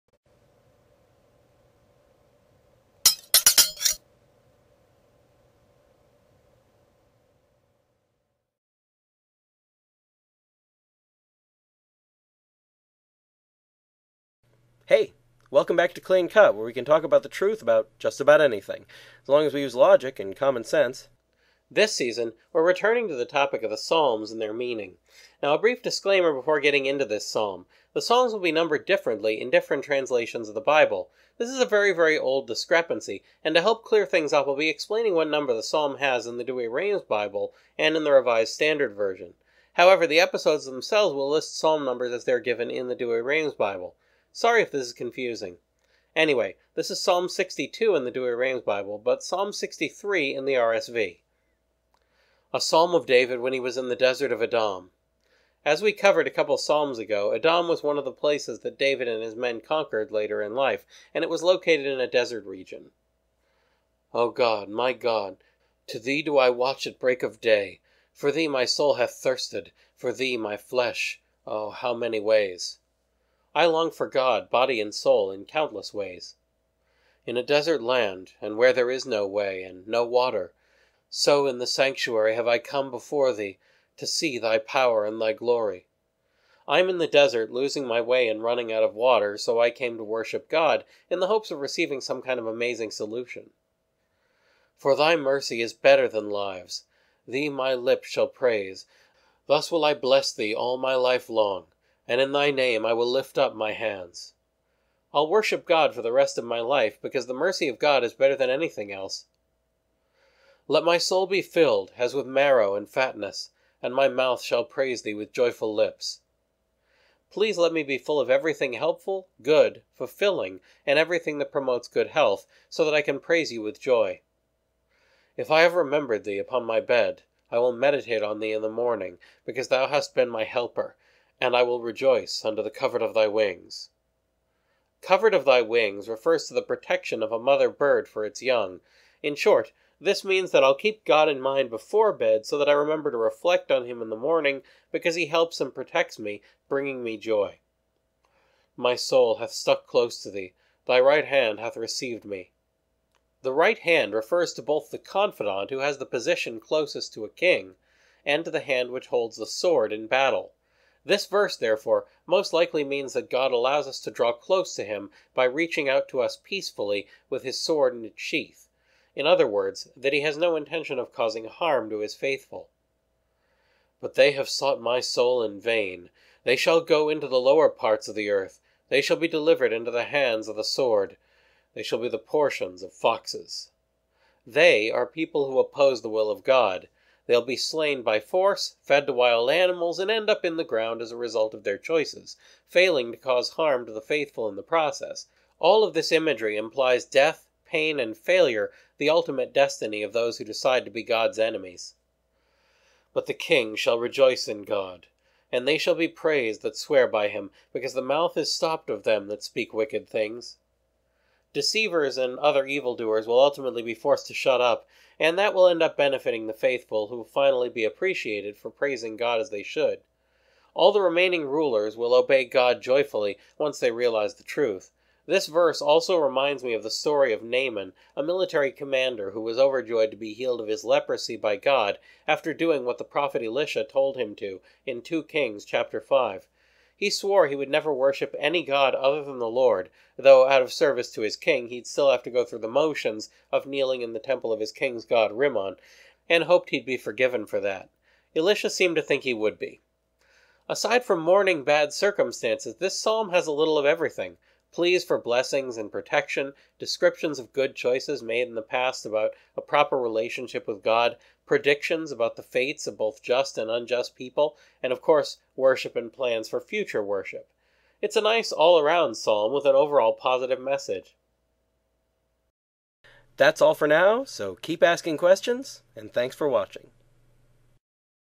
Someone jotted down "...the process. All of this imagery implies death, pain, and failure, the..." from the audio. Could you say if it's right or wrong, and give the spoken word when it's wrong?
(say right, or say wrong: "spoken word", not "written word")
right.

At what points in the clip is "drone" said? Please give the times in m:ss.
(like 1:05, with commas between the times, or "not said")
not said.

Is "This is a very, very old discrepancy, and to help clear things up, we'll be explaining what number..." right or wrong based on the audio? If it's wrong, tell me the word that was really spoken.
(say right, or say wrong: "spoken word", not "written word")
right.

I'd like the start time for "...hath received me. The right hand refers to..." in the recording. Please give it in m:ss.
2:31.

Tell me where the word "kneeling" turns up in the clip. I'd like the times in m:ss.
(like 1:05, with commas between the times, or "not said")
4:03.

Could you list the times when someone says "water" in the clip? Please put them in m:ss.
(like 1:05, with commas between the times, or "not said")
1:20, 1:28.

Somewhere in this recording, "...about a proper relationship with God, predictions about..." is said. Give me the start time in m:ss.
4:19.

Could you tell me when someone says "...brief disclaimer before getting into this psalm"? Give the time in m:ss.
0:25.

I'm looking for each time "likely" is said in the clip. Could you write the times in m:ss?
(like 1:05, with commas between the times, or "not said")
2:42.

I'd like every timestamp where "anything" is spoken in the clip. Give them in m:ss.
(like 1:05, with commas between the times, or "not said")
0:18, 1:48.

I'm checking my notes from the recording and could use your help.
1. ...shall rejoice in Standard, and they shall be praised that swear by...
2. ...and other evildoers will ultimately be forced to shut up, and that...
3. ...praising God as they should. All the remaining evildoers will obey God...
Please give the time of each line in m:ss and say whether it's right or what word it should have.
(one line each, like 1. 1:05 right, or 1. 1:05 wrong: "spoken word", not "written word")
1. 3:23 wrong: "God", not "Standard"
2. 3:32 right
3. 3:38 wrong: "rulers", not "evildoers".